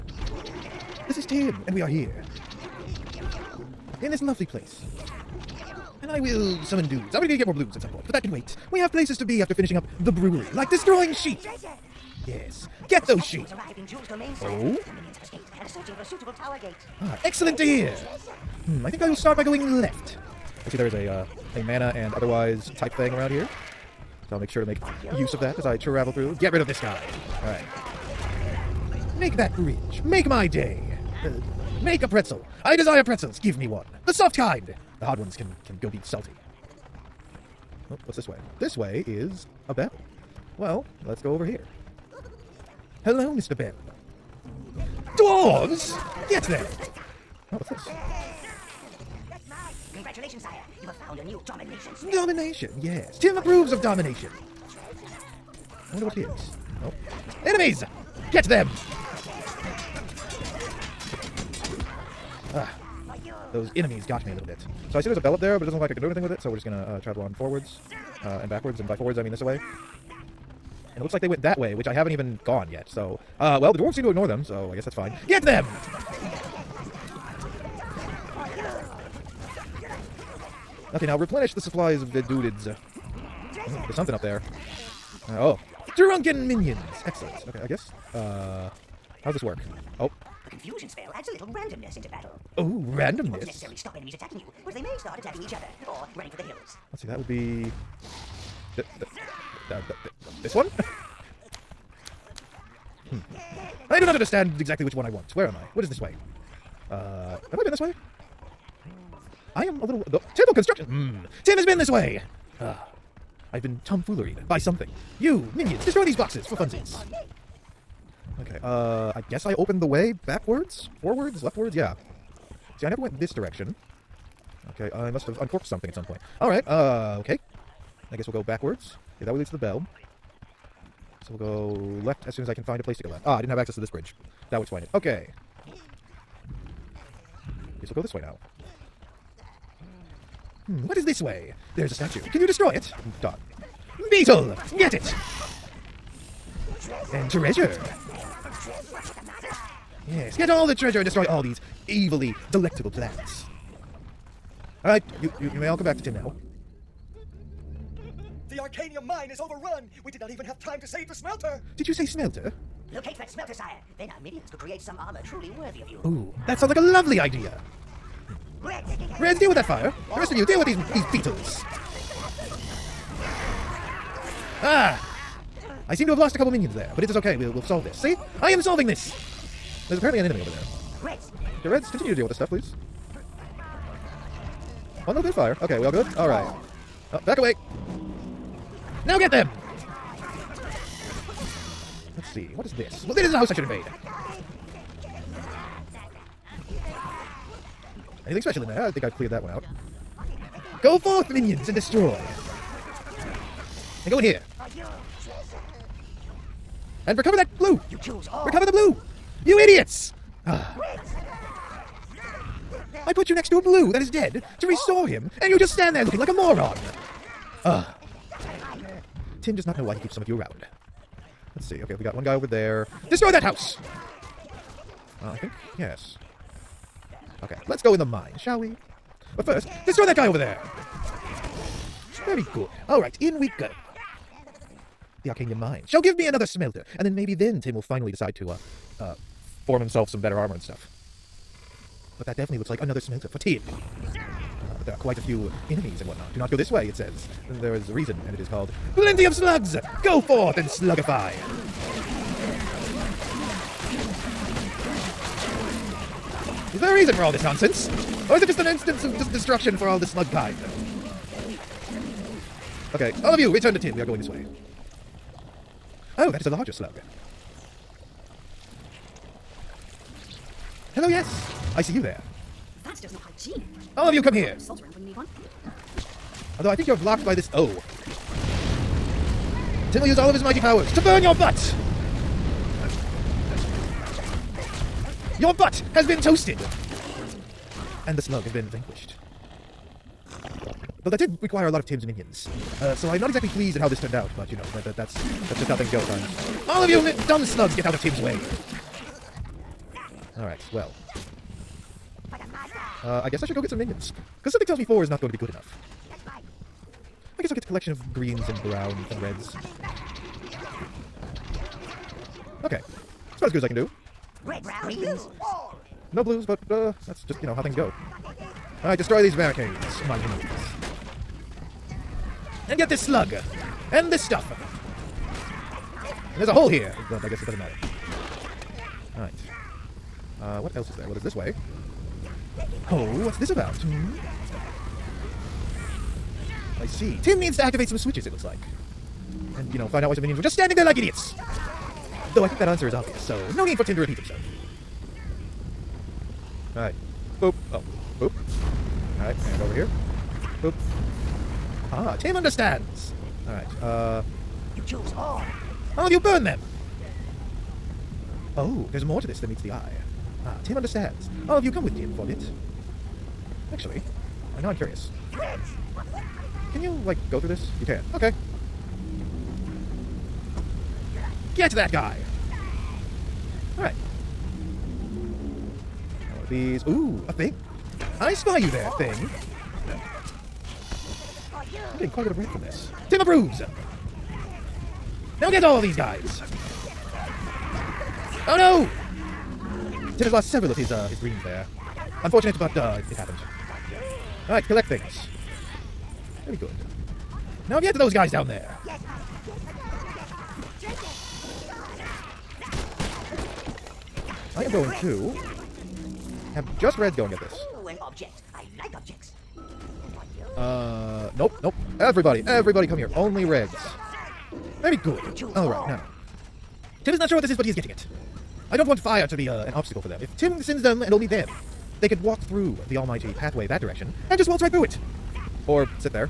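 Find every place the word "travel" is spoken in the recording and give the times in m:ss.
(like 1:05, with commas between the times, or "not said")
0:25, 1:07.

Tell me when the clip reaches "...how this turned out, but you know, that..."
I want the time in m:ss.
4:53.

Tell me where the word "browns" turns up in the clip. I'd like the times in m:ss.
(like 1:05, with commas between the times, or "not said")
5:08, 5:14.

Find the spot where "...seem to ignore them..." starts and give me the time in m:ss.
1:13.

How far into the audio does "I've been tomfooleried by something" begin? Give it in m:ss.
1:53.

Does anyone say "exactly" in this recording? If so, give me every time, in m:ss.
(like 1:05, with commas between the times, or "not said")
1:44, 4:53.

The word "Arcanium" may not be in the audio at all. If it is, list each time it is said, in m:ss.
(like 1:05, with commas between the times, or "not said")
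2:38, 3:55.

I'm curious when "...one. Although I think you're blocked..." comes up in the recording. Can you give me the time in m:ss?
4:35.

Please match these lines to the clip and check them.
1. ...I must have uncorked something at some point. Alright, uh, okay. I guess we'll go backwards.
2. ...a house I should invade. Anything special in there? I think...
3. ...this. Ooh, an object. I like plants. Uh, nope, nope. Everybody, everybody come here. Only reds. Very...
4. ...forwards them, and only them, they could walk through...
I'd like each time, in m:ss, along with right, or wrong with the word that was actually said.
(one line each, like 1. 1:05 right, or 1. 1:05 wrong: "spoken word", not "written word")
1. 2:04 right
2. 3:13 right
3. 6:47 wrong: "objects", not "plants"
4. 7:00 wrong: "sends", not "forwards".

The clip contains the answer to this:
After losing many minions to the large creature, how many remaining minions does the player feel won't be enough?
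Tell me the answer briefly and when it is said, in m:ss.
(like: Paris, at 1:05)
4, at 5:04.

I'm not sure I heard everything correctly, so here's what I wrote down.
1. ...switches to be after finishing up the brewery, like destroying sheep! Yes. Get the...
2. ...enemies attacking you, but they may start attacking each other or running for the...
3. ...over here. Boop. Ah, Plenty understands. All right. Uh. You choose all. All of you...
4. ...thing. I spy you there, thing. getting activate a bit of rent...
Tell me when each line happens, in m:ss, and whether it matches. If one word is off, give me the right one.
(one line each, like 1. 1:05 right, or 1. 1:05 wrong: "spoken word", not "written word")
1. 0:08 wrong: "places", not "switches"
2. 1:33 right
3. 5:49 wrong: "Tim", not "Plenty"
4. 6:17 wrong: "quite", not "activate".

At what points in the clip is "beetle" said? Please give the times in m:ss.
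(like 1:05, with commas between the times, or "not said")
2:24, 2:51.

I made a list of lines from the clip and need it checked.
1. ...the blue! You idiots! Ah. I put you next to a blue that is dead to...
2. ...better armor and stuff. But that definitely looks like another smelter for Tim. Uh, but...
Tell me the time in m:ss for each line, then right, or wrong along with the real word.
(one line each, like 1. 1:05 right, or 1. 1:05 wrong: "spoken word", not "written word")
1. 3:28 right
2. 4:00 right.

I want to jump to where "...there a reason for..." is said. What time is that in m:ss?
4:16.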